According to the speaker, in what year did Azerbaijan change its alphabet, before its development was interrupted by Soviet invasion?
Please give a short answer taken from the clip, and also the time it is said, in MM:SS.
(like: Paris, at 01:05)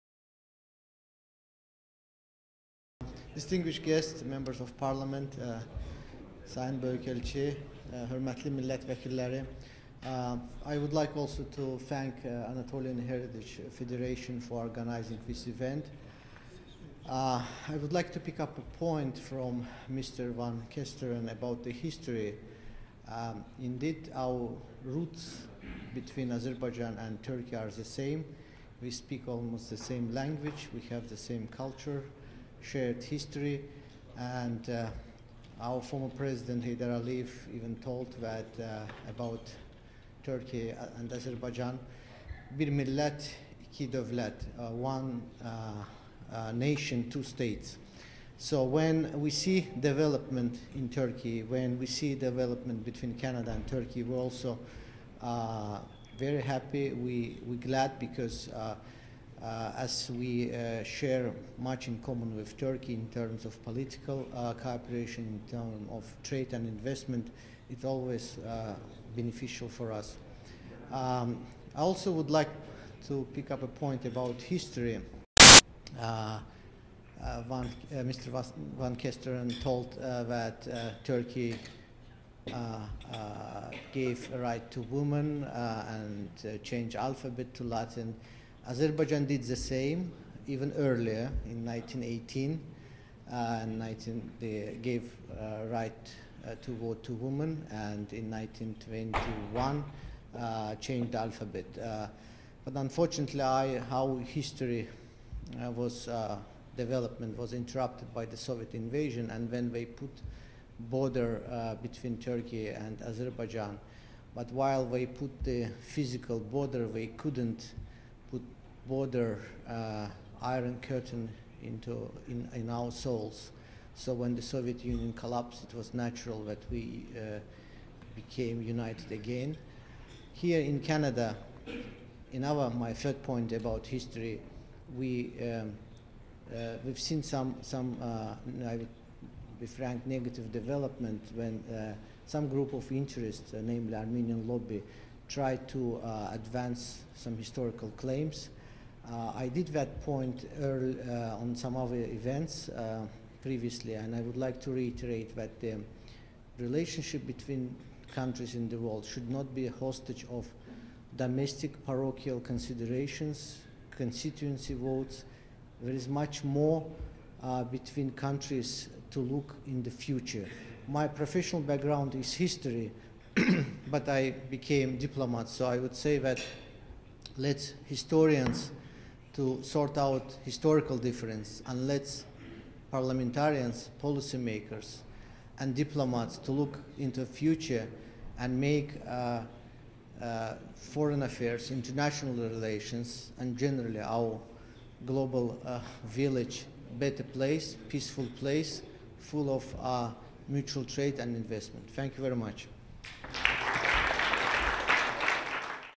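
1921, at 01:38.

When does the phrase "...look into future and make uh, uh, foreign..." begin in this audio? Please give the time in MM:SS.
03:06.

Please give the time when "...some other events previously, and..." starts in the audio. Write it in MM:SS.
02:31.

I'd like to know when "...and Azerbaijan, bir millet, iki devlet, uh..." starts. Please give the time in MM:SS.
00:40.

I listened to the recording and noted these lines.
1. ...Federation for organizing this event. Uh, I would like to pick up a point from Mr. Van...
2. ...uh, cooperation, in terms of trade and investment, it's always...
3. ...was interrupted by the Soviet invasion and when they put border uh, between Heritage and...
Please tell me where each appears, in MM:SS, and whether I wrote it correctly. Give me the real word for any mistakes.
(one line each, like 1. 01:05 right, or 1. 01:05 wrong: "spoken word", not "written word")
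1. 00:13 right
2. 01:04 right
3. 01:47 wrong: "Turkey", not "Heritage".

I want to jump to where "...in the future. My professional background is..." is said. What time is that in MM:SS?
02:49.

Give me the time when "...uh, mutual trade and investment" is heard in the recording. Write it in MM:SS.
03:19.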